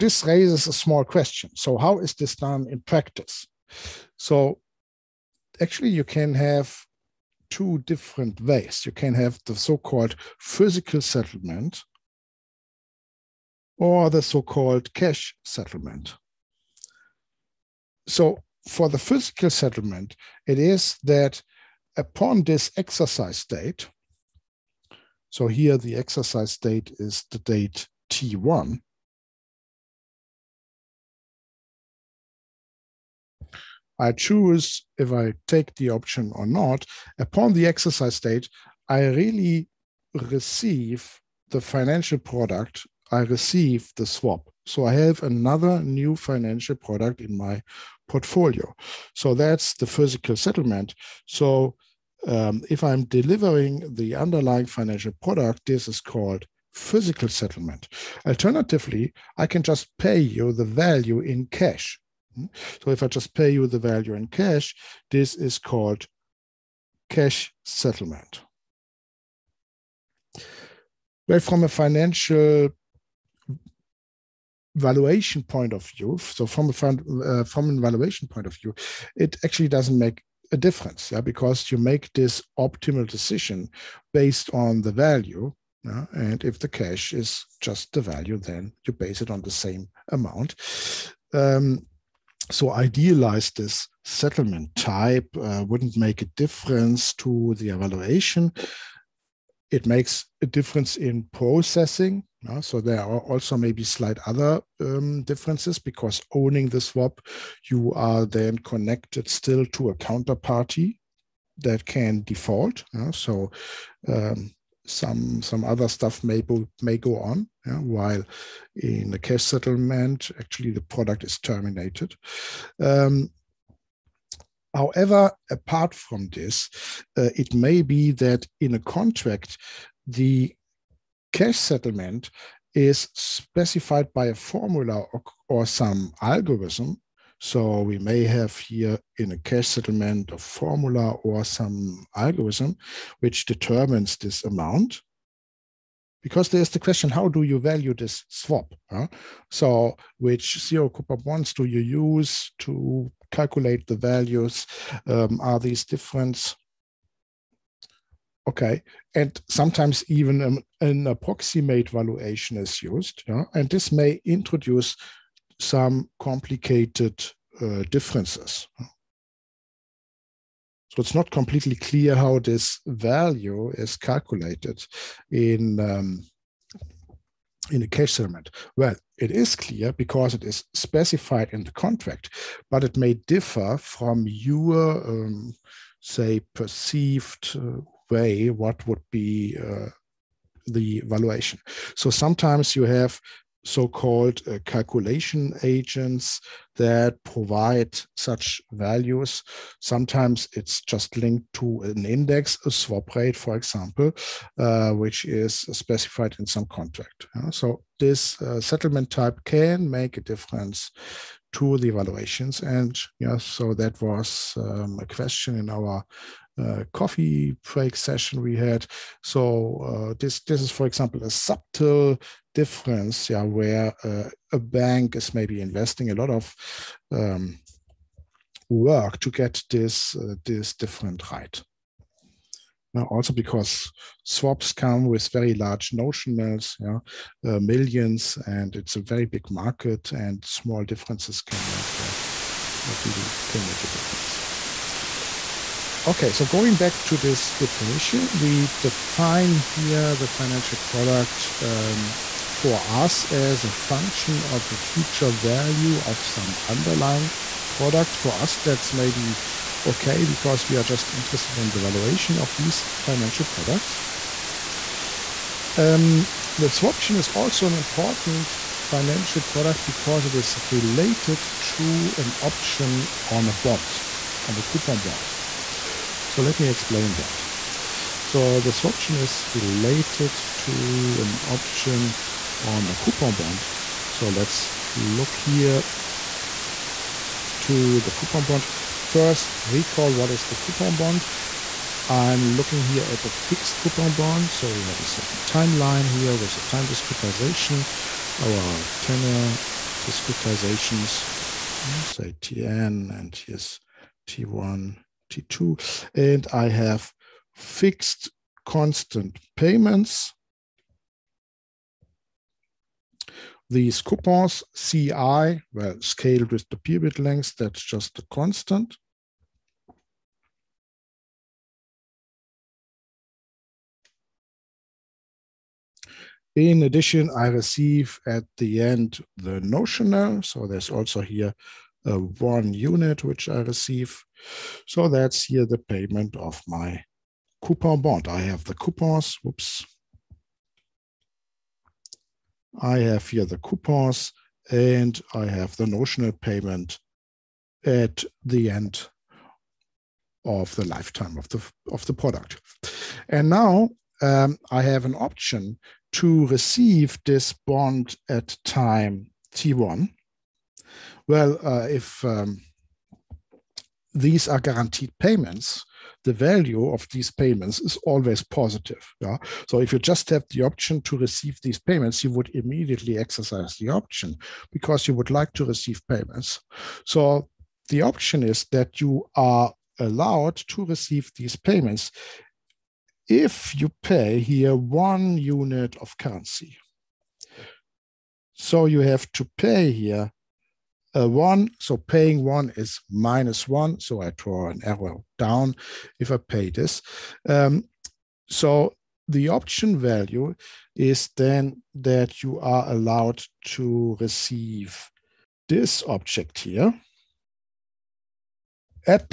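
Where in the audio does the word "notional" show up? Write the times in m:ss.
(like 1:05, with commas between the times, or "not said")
3:55, 5:29, 5:45.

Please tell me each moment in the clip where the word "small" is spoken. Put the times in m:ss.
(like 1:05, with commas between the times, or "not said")
0:00, 4:00.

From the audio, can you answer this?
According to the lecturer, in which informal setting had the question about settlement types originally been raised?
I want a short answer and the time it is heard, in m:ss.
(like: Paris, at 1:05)
Coffee break session, at 3:36.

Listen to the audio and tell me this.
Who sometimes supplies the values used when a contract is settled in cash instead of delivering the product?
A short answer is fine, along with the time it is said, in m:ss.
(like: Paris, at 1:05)
Calculation agents, at 3:14.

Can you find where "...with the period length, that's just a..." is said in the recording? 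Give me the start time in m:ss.
5:16.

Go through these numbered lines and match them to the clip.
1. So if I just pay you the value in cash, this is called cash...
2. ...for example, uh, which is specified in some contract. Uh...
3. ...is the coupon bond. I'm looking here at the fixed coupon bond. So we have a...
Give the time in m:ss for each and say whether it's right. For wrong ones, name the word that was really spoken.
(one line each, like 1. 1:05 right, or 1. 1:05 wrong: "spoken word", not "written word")
1. 1:02 right
2. 3:23 right
3. 4:50 right.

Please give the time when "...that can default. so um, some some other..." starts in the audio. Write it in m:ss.
1:51.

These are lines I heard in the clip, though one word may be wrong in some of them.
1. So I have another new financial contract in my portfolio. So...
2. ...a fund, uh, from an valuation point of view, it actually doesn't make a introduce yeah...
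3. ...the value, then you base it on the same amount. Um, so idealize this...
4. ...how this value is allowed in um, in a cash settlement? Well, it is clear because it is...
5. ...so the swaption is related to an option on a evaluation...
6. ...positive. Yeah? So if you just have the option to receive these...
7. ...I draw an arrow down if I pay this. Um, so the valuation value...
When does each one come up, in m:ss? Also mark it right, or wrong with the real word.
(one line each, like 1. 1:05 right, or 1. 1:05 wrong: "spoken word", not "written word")
1. 0:44 wrong: "product", not "contract"
2. 1:16 wrong: "difference", not "introduce"
3. 1:27 right
4. 2:52 wrong: "calculated", not "allowed"
5. 4:38 wrong: "coupon", not "evaluation"
6. 6:08 right
7. 6:34 wrong: "option", not "valuation".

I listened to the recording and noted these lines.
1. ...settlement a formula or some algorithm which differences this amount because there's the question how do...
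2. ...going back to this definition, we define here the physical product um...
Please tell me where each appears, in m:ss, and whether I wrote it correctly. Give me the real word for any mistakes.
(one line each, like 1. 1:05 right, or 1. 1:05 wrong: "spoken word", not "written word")
1. 2:19 wrong: "determines", not "differences"
2. 4:06 wrong: "financial", not "physical".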